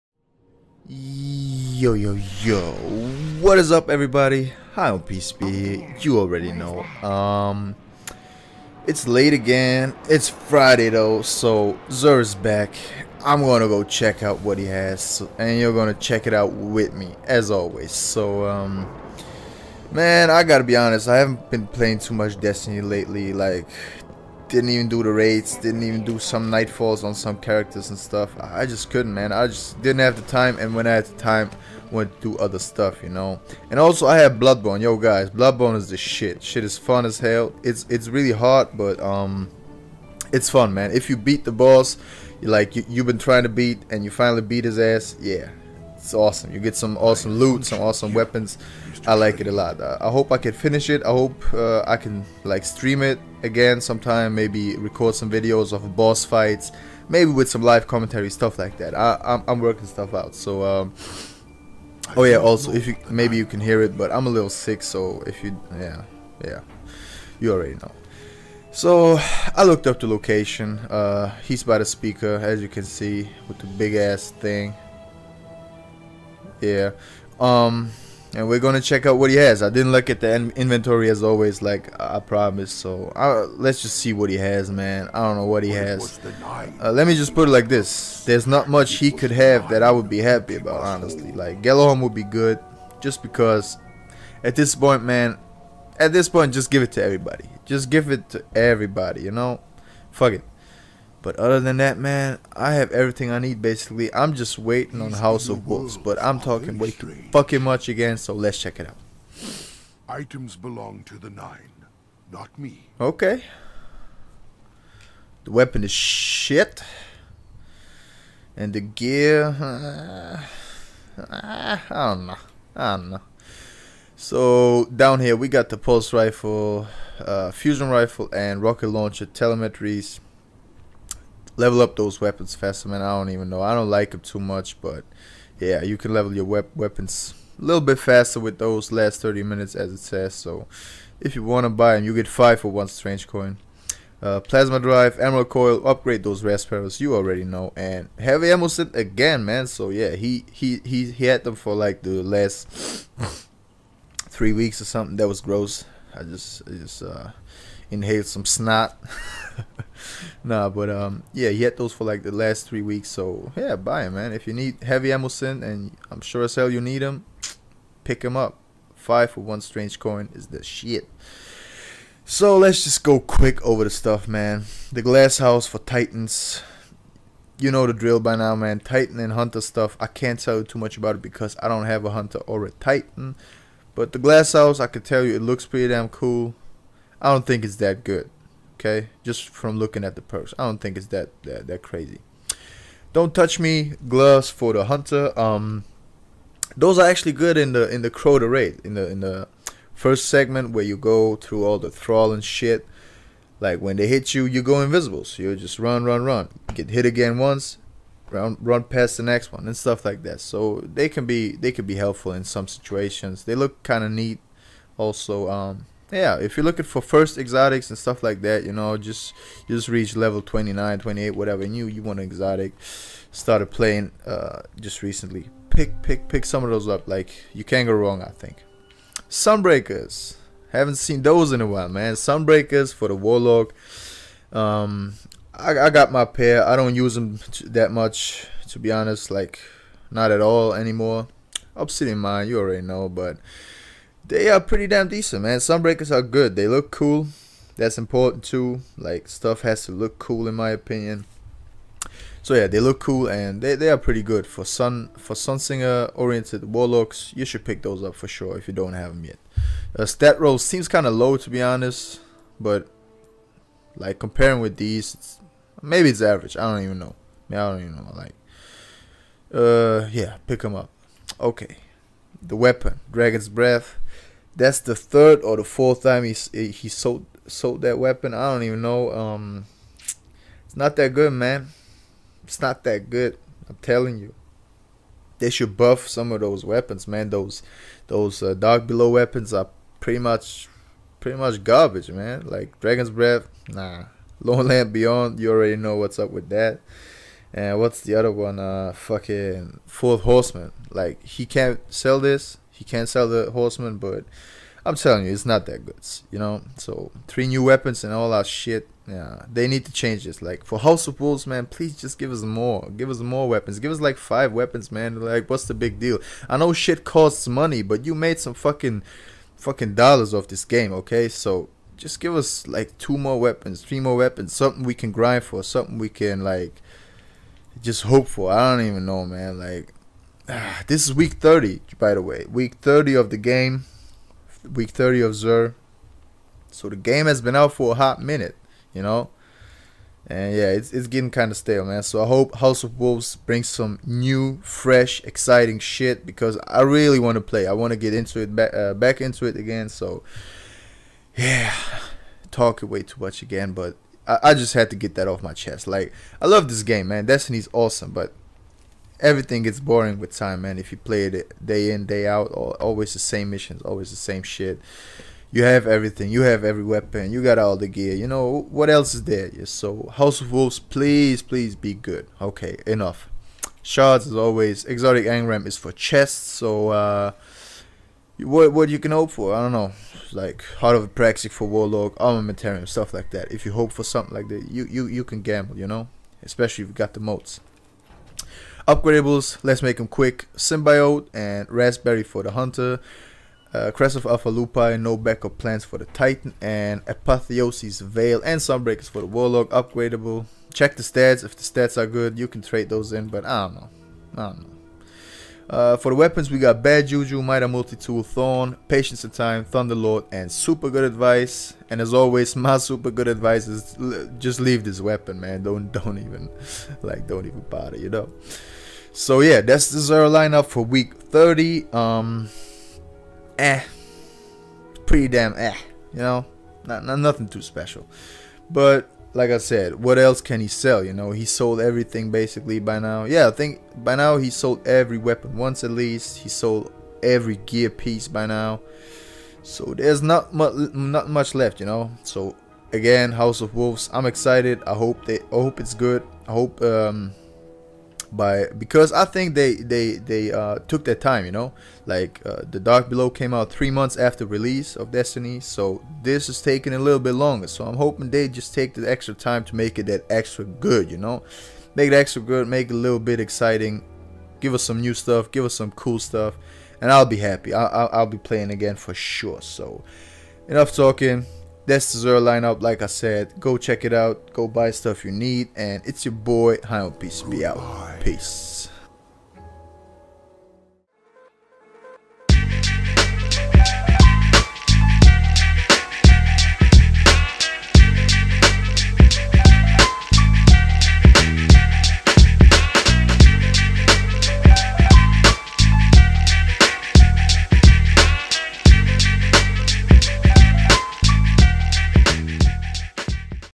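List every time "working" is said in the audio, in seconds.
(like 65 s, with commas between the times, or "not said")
59 s.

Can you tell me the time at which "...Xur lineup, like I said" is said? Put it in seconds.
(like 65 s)
472 s.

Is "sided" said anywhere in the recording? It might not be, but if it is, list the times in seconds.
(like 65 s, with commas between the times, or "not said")
not said.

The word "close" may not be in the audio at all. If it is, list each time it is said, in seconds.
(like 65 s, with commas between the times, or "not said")
not said.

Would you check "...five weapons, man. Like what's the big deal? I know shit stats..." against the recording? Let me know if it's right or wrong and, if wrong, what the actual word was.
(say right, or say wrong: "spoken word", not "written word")
wrong: "costs", not "stats".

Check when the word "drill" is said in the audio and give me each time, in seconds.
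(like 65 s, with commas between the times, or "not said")
177 s.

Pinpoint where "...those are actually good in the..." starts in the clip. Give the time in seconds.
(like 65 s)
196 s.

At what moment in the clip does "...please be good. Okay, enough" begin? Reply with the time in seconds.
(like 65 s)
371 s.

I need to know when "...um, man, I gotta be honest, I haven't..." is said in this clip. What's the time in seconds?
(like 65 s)
18 s.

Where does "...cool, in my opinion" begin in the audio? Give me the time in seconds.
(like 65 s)
250 s.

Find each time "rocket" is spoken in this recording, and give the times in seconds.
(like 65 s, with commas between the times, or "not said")
128 s.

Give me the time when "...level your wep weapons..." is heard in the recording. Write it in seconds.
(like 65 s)
136 s.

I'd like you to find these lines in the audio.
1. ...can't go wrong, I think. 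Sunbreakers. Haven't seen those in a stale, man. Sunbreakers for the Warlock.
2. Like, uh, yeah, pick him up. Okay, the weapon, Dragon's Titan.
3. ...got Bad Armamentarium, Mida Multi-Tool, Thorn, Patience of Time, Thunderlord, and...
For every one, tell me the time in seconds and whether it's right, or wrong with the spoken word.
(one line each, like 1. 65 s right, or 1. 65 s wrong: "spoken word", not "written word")
1. 227 s wrong: "while", not "stale"
2. 268 s wrong: "Breath", not "Titan"
3. 406 s wrong: "Juju", not "Armamentarium".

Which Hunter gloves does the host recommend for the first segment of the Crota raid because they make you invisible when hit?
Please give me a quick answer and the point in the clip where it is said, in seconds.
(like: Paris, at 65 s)
Don't Touch Me, at 193 s.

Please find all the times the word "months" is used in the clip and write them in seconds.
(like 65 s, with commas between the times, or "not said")
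453 s.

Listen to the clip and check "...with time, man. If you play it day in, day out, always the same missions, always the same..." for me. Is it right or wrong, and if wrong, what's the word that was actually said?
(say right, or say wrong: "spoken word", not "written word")
right.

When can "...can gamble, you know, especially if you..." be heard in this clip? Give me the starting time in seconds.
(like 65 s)
385 s.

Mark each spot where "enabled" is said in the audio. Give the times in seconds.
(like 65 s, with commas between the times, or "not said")
not said.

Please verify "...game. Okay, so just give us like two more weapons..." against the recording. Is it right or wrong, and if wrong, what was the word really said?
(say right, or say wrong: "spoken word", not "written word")
right.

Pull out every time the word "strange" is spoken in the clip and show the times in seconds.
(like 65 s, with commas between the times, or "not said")
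142 s, 169 s.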